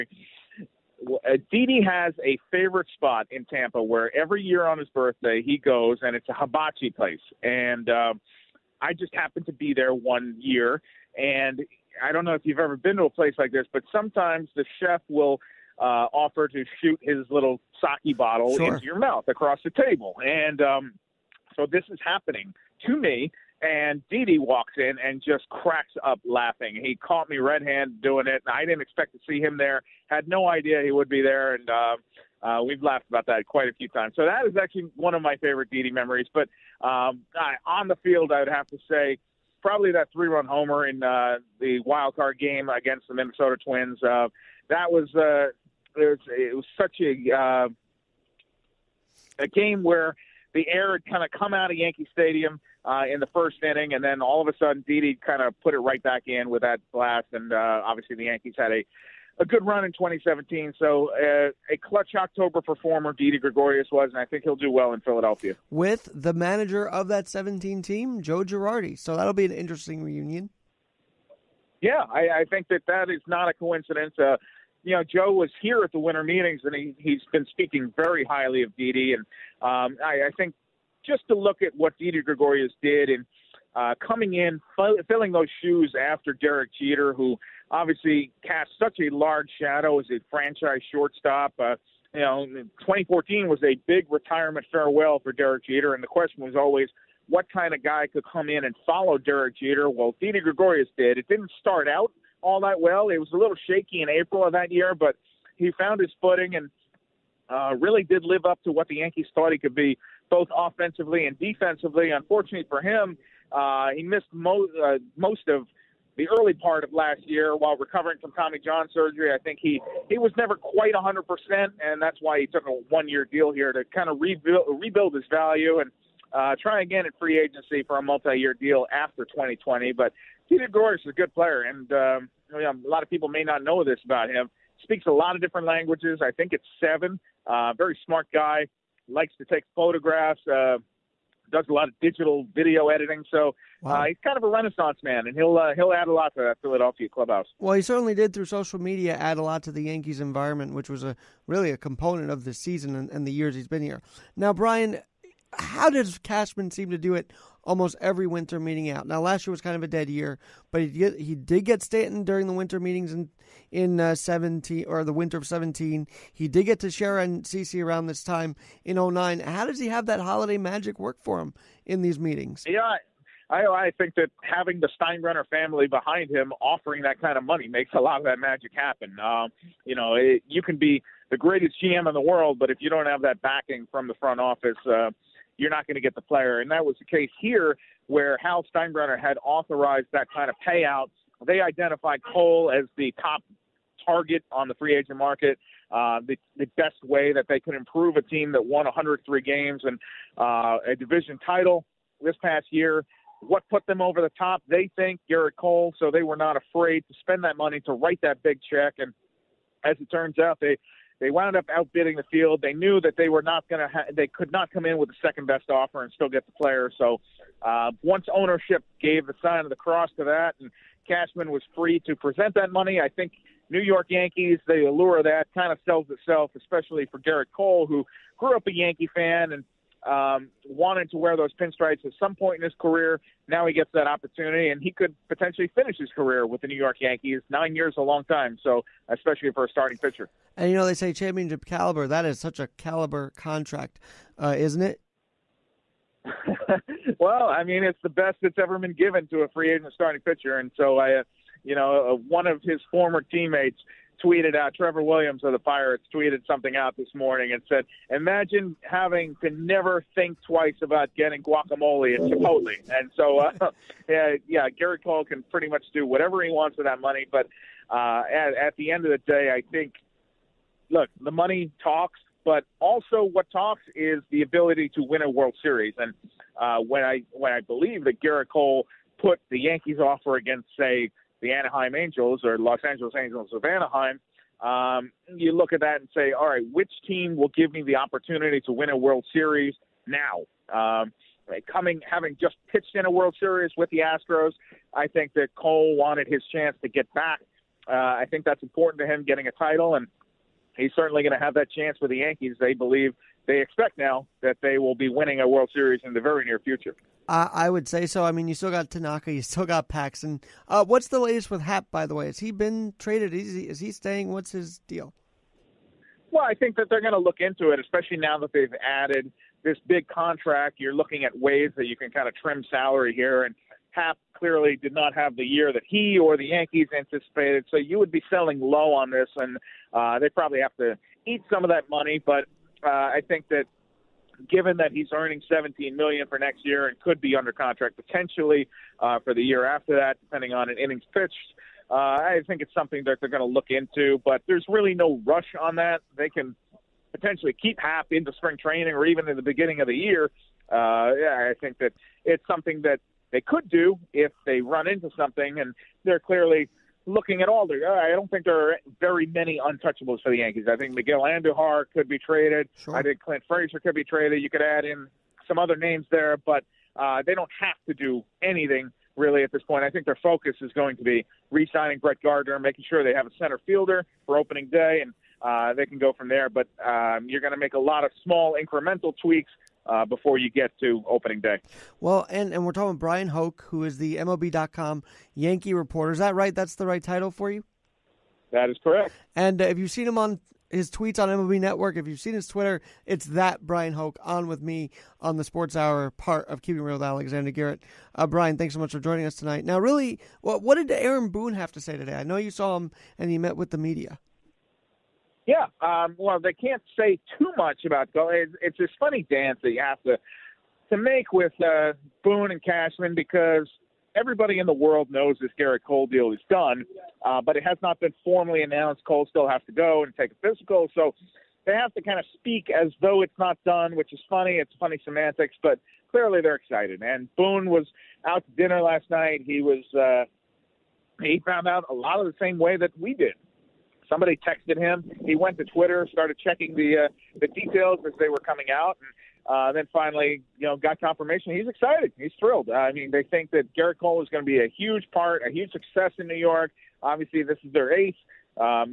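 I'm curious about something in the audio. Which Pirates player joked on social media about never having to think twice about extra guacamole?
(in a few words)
Trevor Williams.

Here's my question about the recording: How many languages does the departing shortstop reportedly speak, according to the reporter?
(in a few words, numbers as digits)
7.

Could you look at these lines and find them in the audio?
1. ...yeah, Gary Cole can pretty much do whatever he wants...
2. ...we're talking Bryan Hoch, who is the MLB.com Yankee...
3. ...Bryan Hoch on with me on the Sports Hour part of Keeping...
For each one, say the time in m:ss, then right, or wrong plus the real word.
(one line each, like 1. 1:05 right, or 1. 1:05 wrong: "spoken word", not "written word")
1. 4:24 right
2. 6:22 right
3. 6:33 right.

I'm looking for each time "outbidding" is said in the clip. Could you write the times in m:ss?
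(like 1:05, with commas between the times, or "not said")
3:31.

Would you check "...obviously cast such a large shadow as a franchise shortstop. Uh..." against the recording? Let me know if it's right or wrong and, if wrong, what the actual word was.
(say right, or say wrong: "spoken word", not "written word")
right.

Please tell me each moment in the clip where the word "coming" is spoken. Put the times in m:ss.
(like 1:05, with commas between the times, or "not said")
1:24, 4:51, 7:18.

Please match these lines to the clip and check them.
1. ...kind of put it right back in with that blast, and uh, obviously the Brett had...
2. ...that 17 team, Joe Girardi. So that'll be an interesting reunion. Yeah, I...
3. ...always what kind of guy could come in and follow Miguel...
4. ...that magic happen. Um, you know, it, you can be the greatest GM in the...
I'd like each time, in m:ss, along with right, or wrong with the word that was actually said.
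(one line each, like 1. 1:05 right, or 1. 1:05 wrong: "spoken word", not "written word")
1. 0:55 wrong: "Yankees", not "Brett"
2. 1:07 right
3. 1:36 wrong: "Derek", not "Miguel"
4. 2:58 right.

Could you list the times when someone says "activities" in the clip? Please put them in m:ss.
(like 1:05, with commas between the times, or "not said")
not said.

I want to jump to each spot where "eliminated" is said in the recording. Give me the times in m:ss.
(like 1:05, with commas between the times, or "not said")
not said.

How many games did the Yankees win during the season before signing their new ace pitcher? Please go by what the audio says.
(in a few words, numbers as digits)
103.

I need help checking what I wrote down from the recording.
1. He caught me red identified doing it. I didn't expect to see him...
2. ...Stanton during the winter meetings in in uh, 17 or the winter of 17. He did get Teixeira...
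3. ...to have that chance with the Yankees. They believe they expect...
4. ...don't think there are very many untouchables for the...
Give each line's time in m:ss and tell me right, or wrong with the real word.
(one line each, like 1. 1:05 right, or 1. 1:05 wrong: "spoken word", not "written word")
1. 0:26 wrong: "handed", not "identified"
2. 2:41 right
3. 5:01 right
4. 5:58 right.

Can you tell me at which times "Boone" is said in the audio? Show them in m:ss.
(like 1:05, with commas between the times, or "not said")
6:41, 6:52, 7:07.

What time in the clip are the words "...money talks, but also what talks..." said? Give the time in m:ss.
4:31.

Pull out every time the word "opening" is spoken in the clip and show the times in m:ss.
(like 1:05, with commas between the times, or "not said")
6:14, 6:21.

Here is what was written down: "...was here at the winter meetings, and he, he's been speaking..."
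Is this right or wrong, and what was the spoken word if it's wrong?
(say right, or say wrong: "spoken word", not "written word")
right.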